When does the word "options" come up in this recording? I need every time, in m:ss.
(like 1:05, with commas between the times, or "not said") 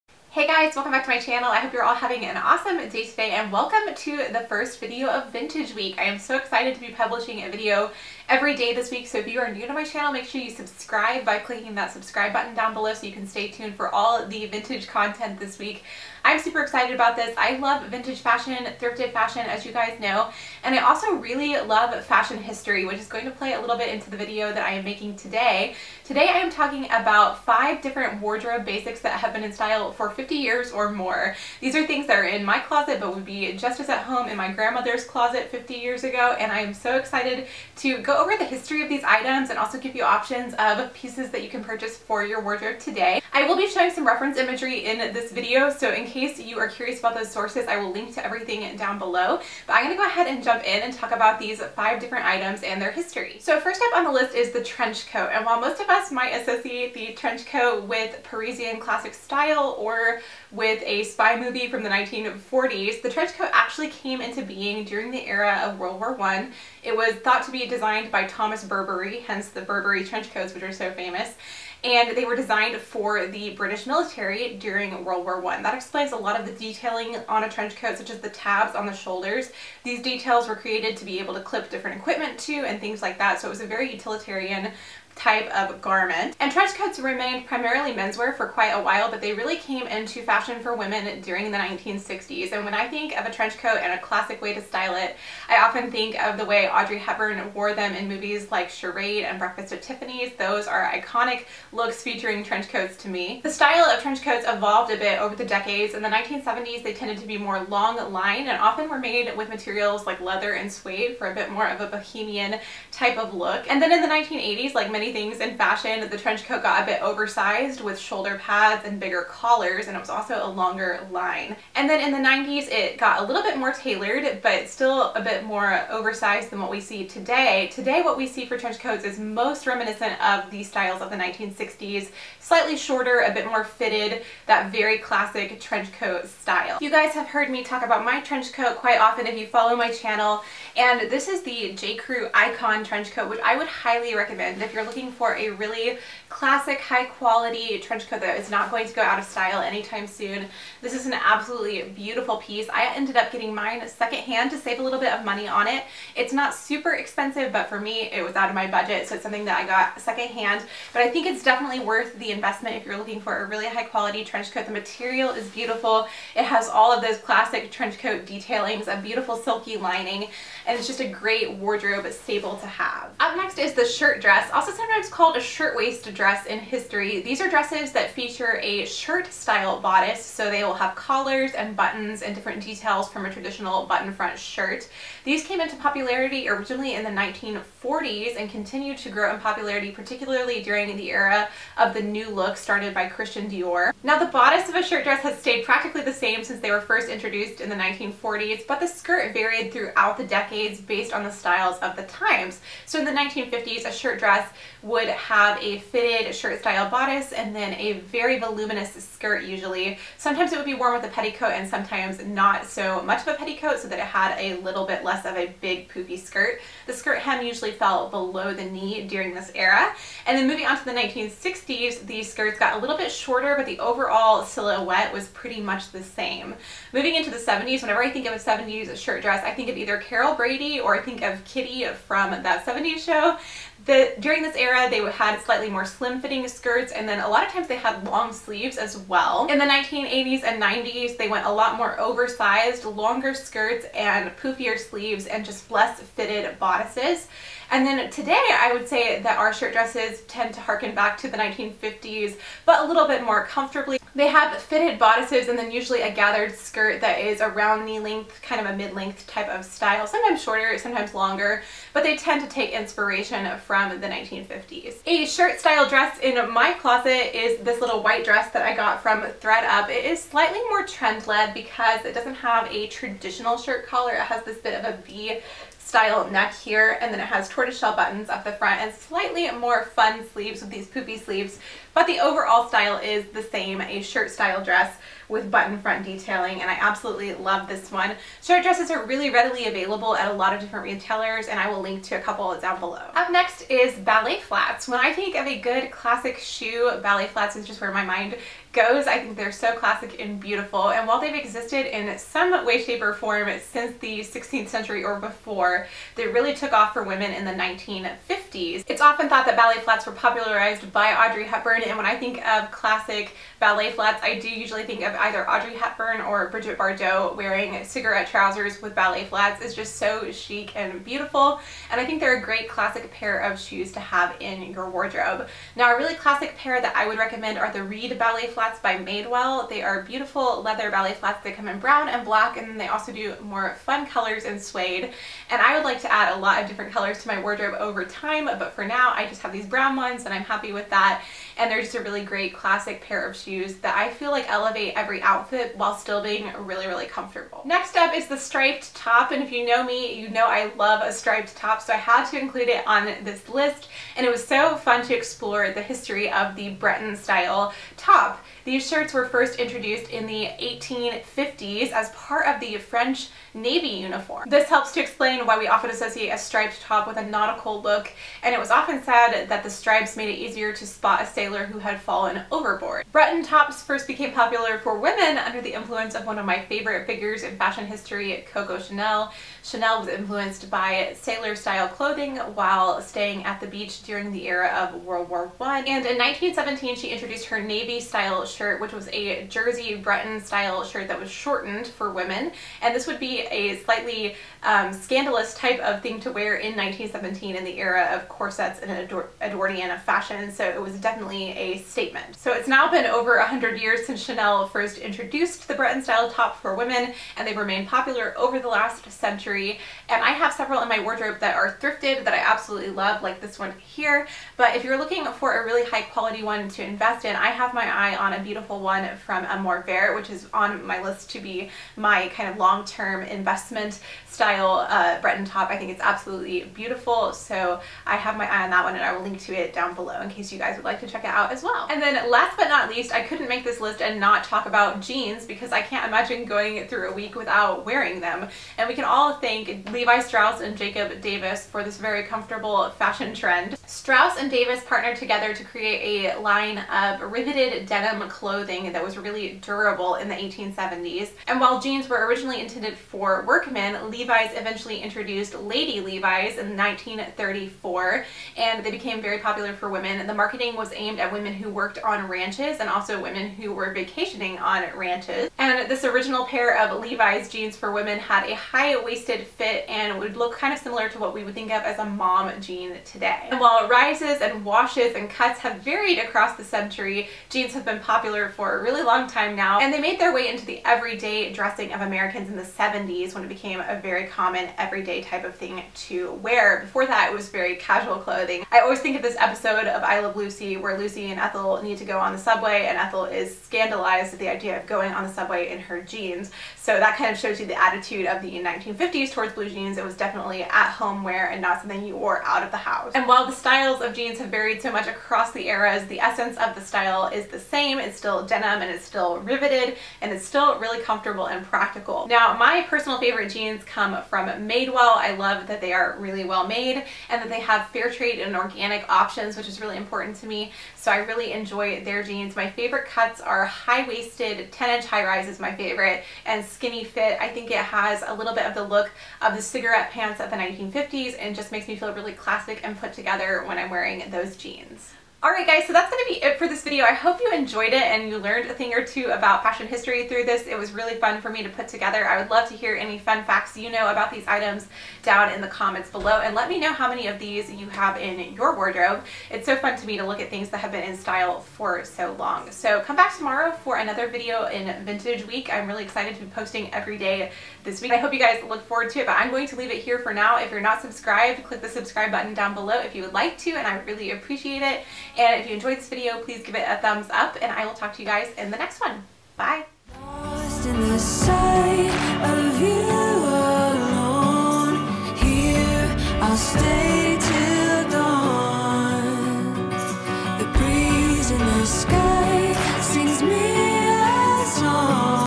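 0:40, 8:39.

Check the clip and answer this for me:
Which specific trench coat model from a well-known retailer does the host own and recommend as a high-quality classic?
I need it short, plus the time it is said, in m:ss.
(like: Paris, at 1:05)
J. Crew Icon trench coat, at 2:21.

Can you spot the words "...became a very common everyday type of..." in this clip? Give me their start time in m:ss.
8:03.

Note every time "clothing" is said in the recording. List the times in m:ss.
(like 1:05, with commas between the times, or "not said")
6:21, 7:28, 8:08.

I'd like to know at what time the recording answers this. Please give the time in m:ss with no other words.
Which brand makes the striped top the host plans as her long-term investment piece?
6:59.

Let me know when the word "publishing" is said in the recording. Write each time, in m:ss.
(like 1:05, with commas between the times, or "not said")
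0:06.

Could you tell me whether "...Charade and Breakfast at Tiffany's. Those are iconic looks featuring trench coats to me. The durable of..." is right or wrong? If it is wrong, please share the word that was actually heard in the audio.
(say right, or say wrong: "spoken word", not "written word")
wrong: "style", not "durable".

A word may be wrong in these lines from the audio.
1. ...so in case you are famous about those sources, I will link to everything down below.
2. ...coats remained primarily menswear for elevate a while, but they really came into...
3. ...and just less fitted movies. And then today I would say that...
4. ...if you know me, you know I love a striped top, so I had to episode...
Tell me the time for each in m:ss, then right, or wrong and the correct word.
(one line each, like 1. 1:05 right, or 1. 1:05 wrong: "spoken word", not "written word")
1. 0:45 wrong: "curious", not "famous"
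2. 1:26 wrong: "quite", not "elevate"
3. 4:05 wrong: "bodices", not "movies"
4. 5:49 wrong: "include", not "episode".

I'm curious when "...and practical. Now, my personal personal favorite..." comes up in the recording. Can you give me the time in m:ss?
8:31.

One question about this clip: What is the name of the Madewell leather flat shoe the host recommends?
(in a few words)
Reid ballet flats.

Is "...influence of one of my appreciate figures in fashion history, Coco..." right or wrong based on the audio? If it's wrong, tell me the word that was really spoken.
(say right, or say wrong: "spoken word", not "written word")
wrong: "favorite", not "appreciate".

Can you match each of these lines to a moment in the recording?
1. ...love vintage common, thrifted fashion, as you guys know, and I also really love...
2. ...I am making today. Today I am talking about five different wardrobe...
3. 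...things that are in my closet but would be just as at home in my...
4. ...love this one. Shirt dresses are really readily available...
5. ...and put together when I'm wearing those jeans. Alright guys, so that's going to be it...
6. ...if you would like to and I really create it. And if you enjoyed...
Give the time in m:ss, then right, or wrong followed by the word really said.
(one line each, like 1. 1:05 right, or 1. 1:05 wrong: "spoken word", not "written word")
1. 0:17 wrong: "fashion", not "common"
2. 0:24 right
3. 0:31 right
4. 4:47 right
5. 8:52 right
6. 9:23 wrong: "appreciate", not "create".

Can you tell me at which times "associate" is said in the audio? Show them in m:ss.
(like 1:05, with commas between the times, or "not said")
0:56, 6:05.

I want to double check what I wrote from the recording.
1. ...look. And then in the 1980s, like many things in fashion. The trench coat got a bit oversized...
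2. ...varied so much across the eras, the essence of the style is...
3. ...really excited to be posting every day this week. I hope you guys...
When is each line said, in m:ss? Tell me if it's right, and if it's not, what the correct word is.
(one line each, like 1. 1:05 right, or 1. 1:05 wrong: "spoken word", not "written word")
1. 1:53 right
2. 8:24 right
3. 9:15 right.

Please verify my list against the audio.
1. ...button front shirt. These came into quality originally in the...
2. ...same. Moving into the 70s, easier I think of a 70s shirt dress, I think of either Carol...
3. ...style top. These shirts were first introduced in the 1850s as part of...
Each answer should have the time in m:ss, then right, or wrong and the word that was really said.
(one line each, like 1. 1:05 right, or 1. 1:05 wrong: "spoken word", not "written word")
1. 3:03 wrong: "popularity", not "quality"
2. 3:46 wrong: "whenever", not "easier"
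3. 5:57 right.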